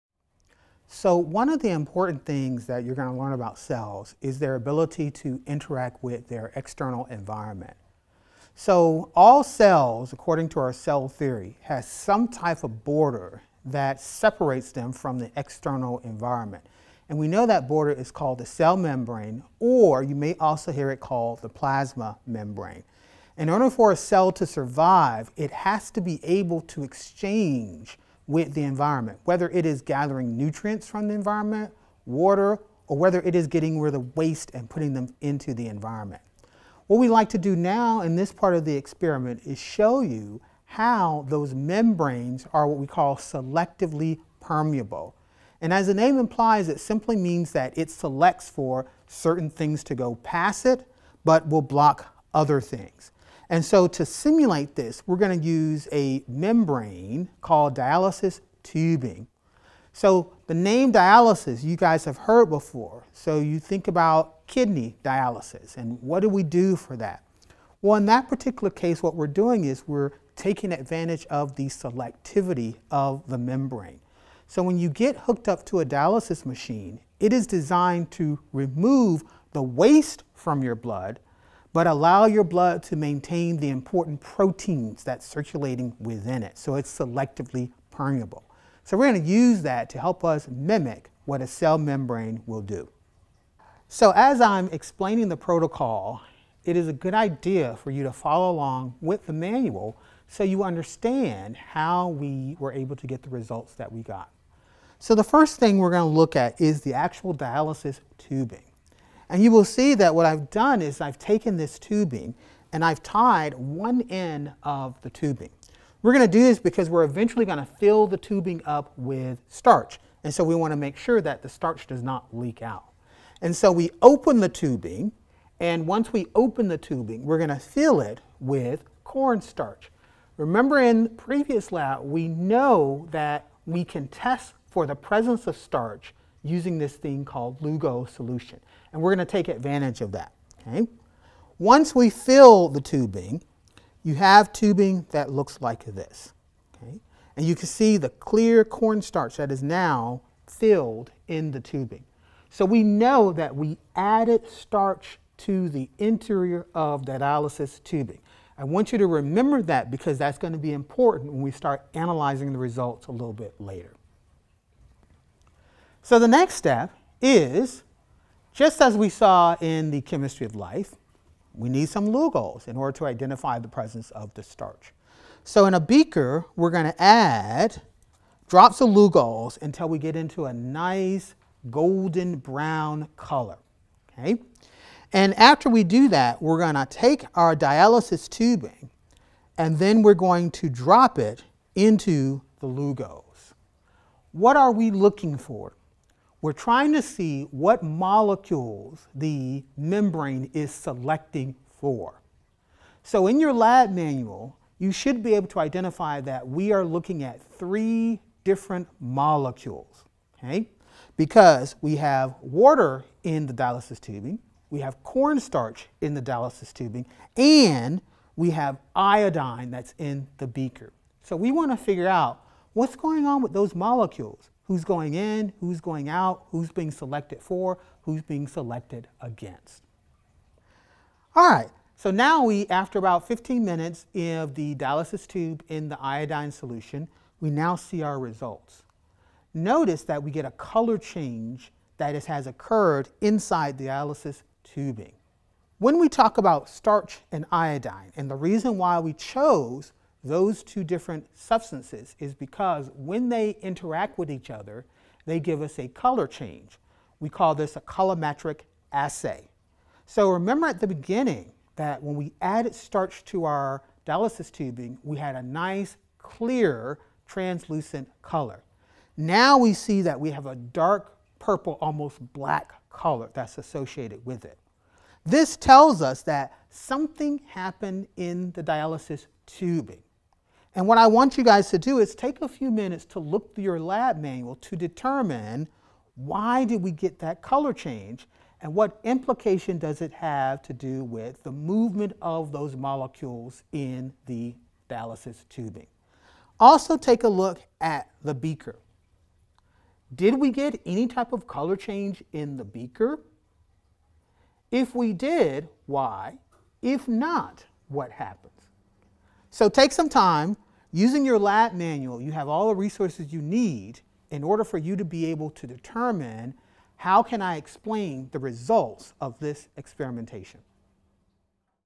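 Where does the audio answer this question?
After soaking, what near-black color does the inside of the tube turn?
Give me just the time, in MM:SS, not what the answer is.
04:30.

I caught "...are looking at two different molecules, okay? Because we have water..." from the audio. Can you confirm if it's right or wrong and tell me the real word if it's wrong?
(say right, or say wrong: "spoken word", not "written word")
wrong: "three", not "two".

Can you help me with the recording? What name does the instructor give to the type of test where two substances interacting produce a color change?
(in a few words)
colorimetric assay.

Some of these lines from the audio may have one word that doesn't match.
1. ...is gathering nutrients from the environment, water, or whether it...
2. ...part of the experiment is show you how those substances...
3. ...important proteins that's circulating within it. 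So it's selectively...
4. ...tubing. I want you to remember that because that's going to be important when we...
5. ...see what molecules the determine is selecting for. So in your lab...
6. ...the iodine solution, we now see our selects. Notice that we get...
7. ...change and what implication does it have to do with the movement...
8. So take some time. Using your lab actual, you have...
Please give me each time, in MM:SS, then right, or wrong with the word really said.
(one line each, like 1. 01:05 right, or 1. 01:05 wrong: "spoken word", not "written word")
1. 00:29 right
2. 00:38 wrong: "membranes", not "substances"
3. 01:23 right
4. 02:37 right
5. 03:17 wrong: "membrane", not "determine"
6. 03:55 wrong: "results", not "selects"
7. 04:47 right
8. 05:09 wrong: "manual", not "actual".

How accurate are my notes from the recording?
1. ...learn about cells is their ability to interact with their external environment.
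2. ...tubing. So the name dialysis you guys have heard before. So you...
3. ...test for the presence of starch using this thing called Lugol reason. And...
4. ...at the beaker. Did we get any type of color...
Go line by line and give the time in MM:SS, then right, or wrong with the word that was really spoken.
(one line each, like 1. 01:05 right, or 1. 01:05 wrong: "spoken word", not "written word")
1. 00:03 right
2. 00:58 right
3. 02:14 wrong: "solution", not "reason"
4. 04:57 right.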